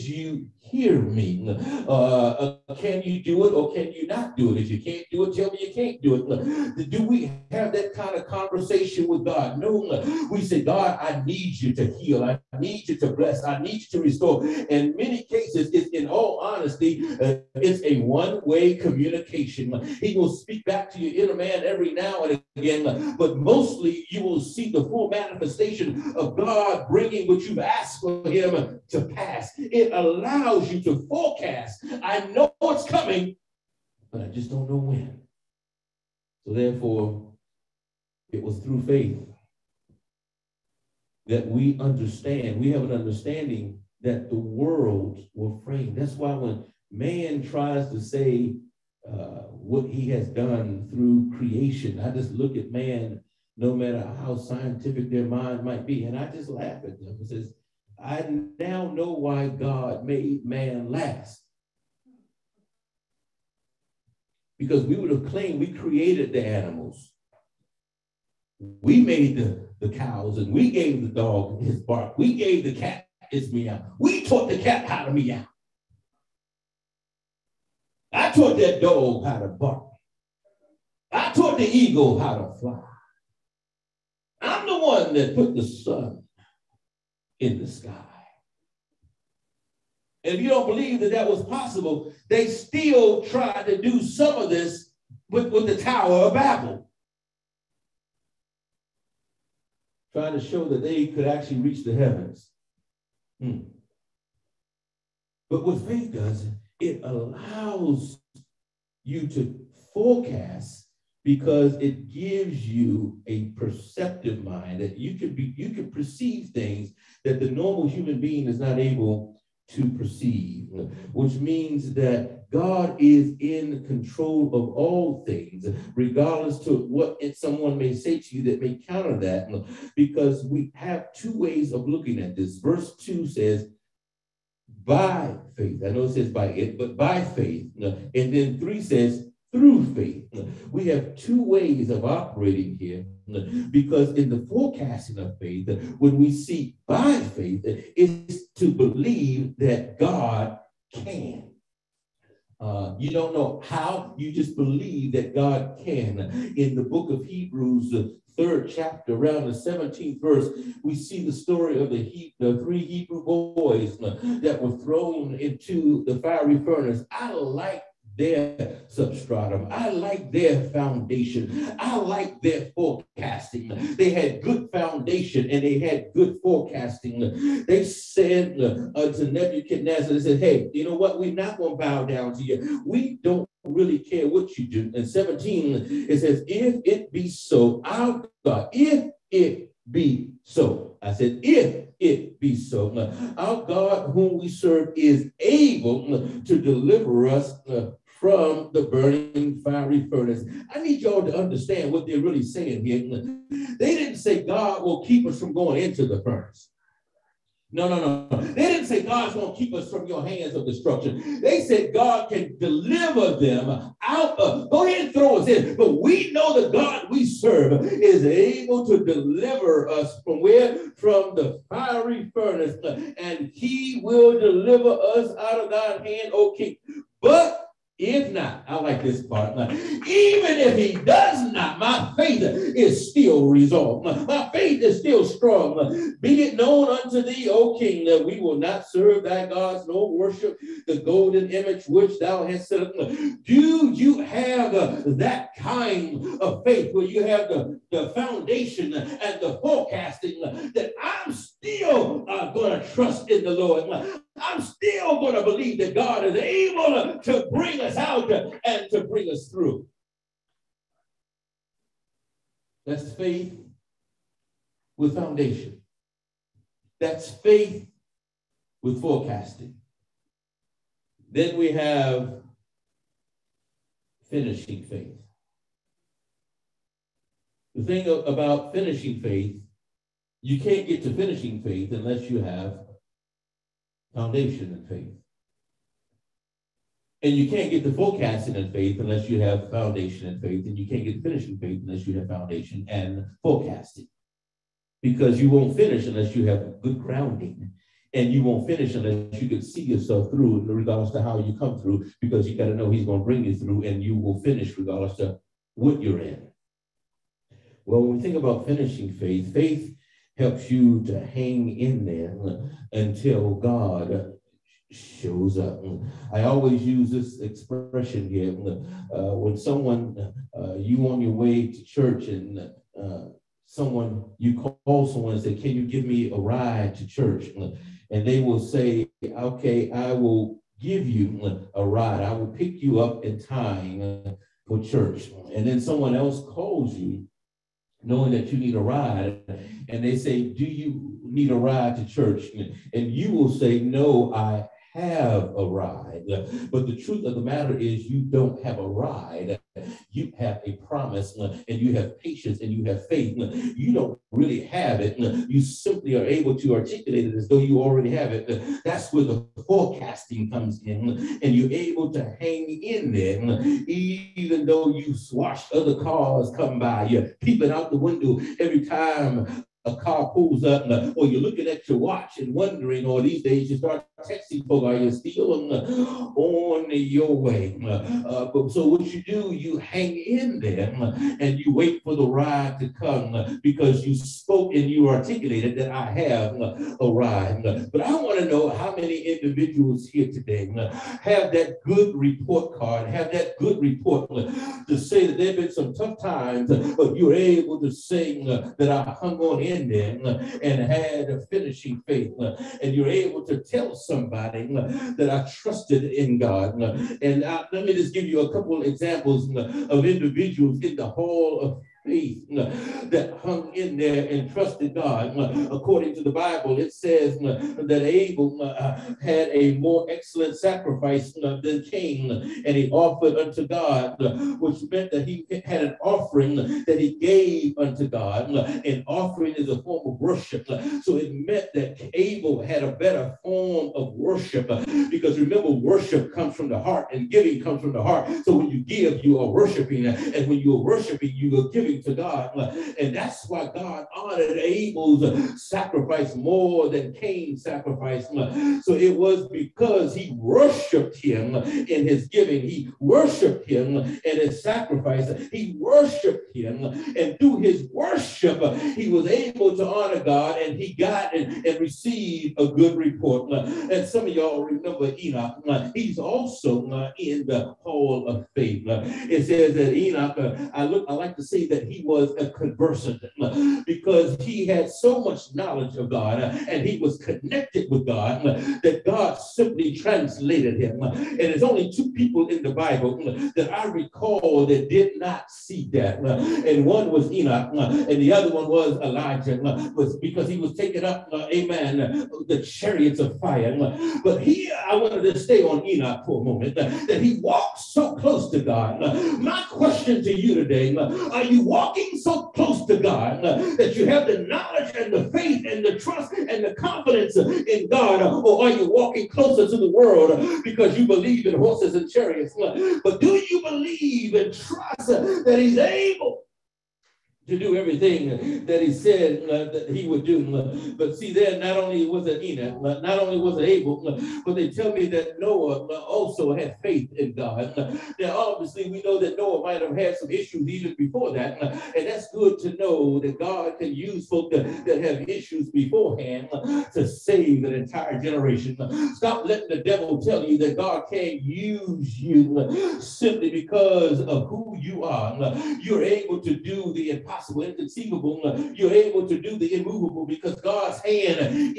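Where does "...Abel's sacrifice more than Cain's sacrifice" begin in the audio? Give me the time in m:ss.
7:24.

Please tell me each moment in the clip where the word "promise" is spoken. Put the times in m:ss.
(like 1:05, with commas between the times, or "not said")
5:50.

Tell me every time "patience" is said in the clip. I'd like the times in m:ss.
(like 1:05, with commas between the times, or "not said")
5:52.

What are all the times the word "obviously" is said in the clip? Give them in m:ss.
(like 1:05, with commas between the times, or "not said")
8:48.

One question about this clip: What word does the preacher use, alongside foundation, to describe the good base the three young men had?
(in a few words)
substratum.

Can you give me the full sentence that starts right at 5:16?
I always use this expression here.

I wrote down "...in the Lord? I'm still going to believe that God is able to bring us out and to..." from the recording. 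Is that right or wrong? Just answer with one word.
right.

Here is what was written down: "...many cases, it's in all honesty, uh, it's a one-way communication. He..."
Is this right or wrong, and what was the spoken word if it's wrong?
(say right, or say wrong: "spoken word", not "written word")
right.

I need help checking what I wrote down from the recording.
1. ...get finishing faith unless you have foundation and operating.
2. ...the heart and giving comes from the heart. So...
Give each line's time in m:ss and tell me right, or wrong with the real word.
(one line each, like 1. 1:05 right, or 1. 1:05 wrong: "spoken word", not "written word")
1. 4:51 wrong: "forecasting", not "operating"
2. 7:16 right.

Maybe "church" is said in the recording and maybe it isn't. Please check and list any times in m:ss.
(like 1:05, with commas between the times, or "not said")
5:21, 5:27, 5:34, 5:42.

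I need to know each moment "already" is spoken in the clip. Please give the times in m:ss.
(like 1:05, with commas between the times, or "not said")
5:57.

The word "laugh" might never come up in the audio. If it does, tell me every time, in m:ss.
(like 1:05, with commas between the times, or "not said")
0:56.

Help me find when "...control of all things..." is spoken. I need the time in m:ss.
2:03.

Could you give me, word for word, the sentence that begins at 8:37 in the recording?
to do everything that he said uh, that he would do.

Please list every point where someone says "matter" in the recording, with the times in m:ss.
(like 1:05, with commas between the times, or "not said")
0:53, 5:47.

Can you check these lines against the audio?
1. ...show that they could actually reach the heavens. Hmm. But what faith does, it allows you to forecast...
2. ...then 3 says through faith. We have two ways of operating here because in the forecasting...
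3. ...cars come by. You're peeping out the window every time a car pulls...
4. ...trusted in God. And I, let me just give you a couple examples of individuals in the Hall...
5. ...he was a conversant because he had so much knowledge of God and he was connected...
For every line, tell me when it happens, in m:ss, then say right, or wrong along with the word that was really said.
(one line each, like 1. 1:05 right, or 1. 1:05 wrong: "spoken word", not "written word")
1. 1:40 right
2. 2:18 right
3. 6:06 right
4. 6:45 right
5. 7:51 right.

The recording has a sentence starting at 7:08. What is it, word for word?
An offering is a form of worship.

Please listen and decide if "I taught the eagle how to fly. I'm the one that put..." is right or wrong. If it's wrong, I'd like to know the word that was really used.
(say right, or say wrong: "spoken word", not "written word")
right.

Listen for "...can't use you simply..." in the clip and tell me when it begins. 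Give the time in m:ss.
9:01.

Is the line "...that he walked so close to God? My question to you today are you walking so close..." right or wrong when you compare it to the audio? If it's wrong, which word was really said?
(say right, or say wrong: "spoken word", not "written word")
right.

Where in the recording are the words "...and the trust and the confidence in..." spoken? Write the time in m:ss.
8:25.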